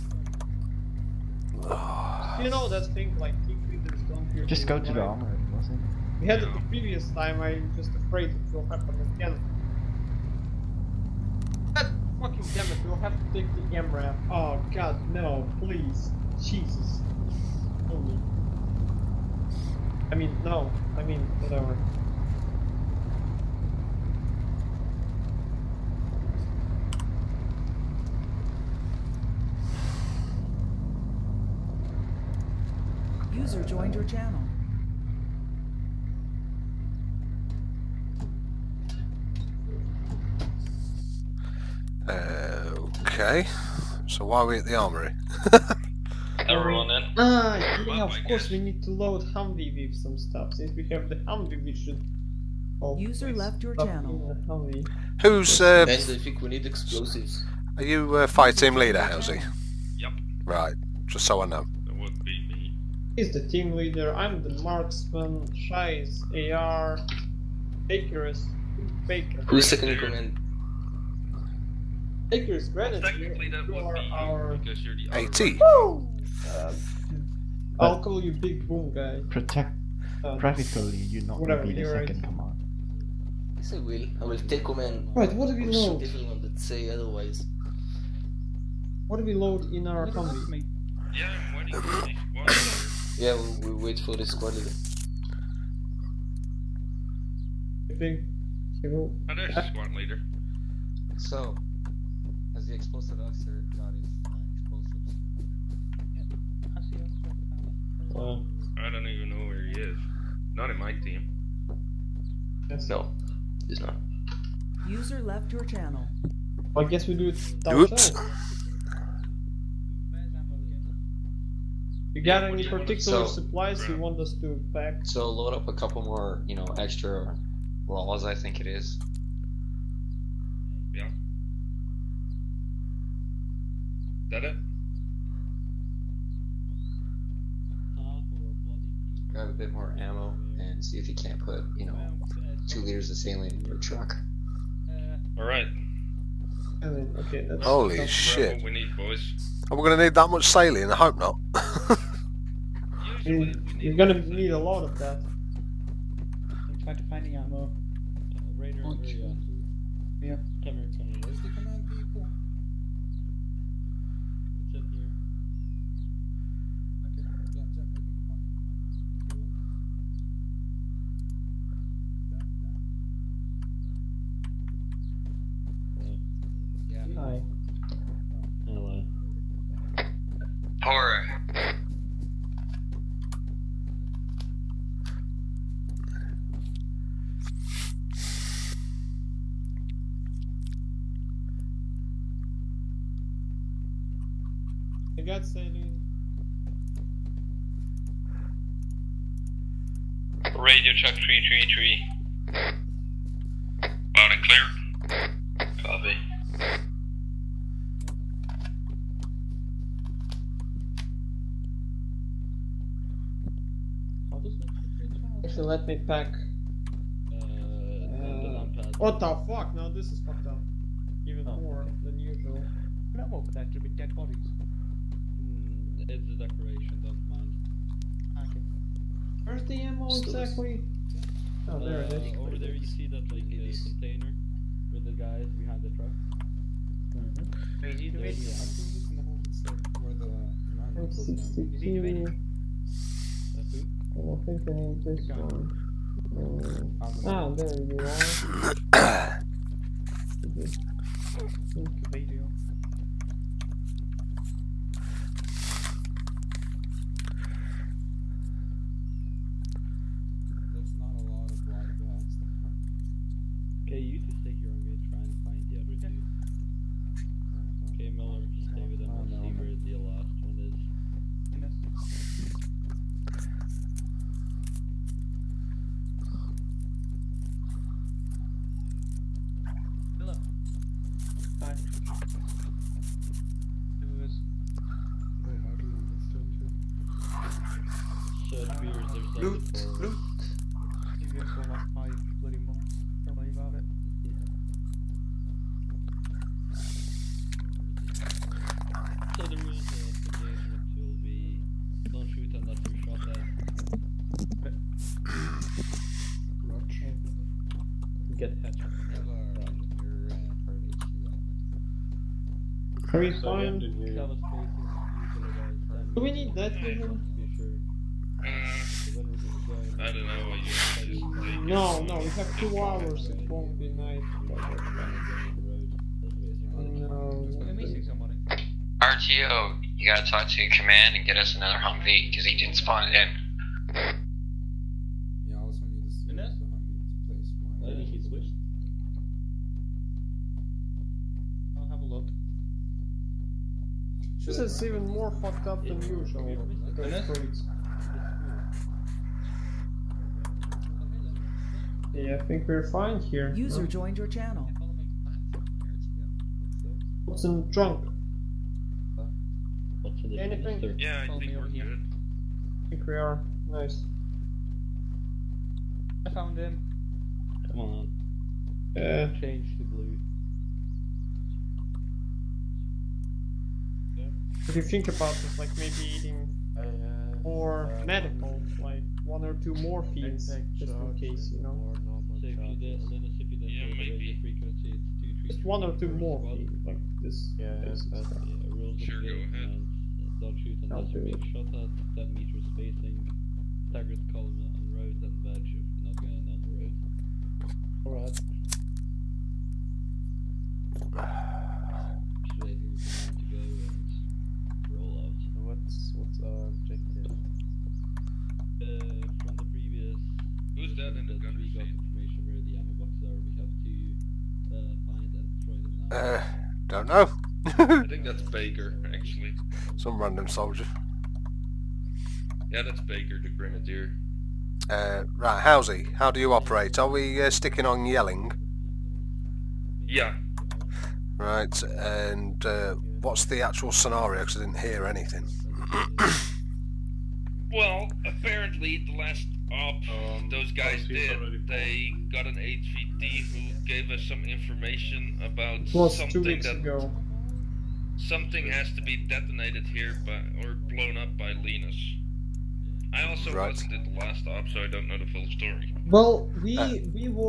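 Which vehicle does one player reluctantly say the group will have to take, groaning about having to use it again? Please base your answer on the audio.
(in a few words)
MRAP.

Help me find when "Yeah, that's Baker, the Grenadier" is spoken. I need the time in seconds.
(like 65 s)
422 s.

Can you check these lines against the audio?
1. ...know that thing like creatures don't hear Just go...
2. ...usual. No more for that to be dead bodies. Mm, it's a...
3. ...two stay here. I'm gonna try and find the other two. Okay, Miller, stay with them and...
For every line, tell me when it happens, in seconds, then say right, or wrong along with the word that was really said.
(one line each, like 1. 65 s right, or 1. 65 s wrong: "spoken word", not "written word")
1. 2 s right
2. 222 s right
3. 264 s right.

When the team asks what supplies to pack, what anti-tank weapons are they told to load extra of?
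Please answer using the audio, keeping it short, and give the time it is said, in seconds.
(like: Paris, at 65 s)
LAWs, at 127 s.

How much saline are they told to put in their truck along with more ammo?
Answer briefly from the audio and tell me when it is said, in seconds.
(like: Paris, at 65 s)
2 liters, at 142 s.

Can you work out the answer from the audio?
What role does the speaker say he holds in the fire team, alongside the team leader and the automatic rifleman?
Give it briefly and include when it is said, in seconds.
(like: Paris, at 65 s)
Marksman, at 64 s.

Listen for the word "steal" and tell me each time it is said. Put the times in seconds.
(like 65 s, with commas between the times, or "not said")
not said.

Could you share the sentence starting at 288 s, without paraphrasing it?
it appears there's loot, for loot.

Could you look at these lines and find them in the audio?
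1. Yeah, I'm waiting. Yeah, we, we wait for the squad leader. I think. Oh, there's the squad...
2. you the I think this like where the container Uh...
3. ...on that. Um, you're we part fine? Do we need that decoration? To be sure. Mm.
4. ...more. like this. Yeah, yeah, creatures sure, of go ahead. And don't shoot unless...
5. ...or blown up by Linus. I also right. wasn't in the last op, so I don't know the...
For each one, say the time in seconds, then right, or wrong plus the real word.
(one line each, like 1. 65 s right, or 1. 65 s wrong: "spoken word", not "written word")
1. 91 s right
2. 238 s wrong: "commander", not "container"
3. 309 s wrong: "vision", not "decoration"
4. 386 s wrong: "rules", not "creatures"
5. 450 s right.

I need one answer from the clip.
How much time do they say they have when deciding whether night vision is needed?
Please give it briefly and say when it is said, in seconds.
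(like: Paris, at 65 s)
2 hours, at 322 s.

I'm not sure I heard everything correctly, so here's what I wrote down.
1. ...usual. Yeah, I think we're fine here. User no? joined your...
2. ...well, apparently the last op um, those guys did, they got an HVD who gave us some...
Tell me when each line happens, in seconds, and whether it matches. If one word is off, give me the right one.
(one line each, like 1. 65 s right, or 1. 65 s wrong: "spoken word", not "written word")
1. 346 s right
2. 437 s right.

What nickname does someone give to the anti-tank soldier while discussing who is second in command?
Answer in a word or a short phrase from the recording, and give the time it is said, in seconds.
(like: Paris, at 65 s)
Big Boom guy, at 78 s.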